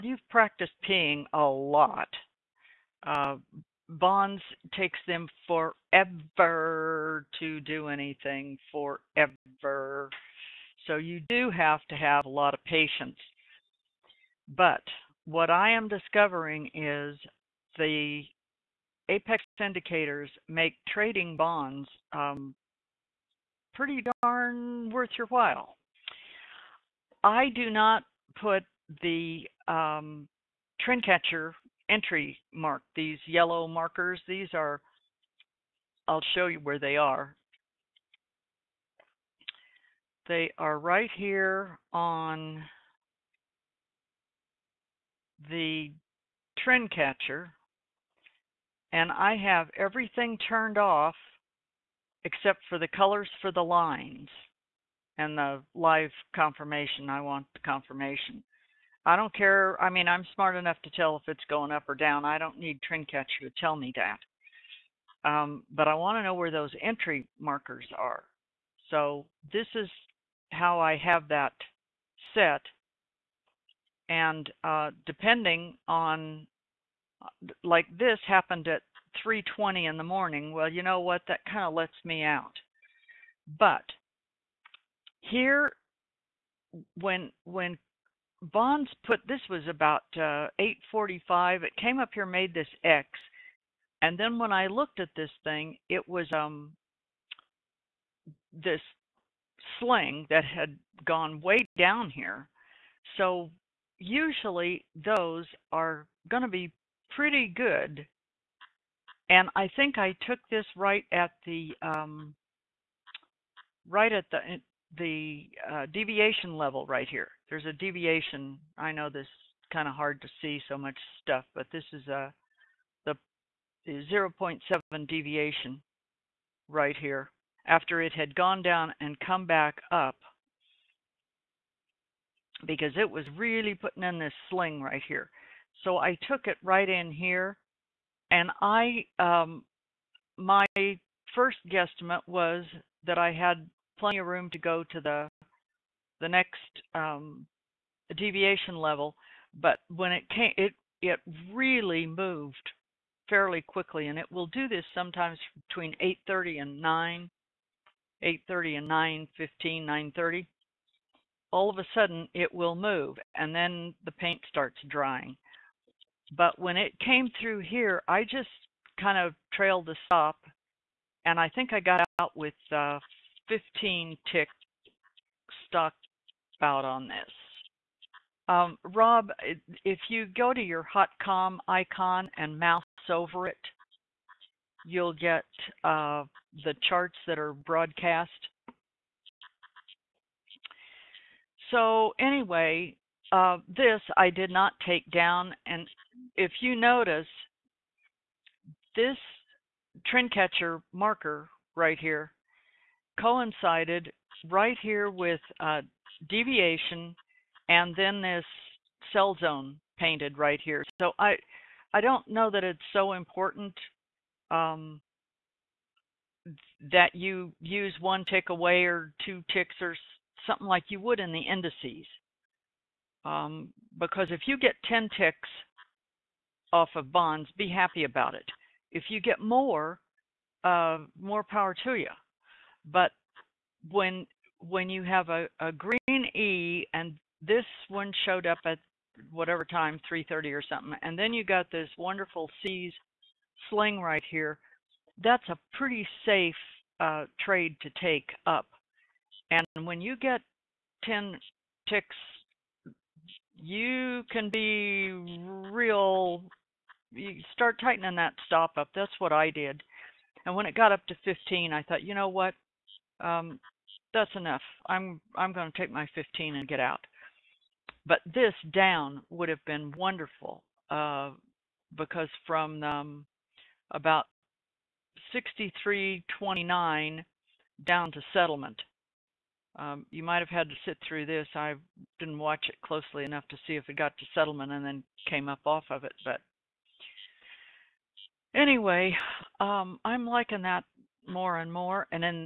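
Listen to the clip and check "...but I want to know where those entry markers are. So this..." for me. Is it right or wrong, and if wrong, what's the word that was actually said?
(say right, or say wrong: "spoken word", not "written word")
right.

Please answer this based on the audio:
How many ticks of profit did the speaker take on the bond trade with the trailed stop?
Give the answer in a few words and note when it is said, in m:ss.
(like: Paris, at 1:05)
15, at 2:53.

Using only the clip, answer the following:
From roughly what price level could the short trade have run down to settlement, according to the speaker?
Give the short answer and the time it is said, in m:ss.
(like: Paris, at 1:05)
63.29, at 4:35.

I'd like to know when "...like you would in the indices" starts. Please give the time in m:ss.
3:40.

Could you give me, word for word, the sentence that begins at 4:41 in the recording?
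I didn't watch it closely enough to see if it got to settlement and then came up off of it.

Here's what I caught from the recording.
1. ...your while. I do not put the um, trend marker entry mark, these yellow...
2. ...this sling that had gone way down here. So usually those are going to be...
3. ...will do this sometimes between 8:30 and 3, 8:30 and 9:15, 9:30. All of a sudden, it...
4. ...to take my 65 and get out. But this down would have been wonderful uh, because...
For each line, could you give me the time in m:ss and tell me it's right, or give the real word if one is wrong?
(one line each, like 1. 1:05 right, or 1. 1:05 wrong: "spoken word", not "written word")
1. 0:25 wrong: "catcher", not "marker"
2. 1:38 right
3. 2:34 wrong: "9", not "3"
4. 4:25 wrong: "15", not "65".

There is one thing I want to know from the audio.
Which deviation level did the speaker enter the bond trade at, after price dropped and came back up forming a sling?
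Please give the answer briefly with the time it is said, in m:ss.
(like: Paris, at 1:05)
0.7, at 2:04.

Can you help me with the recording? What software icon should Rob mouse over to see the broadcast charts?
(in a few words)
HotComm.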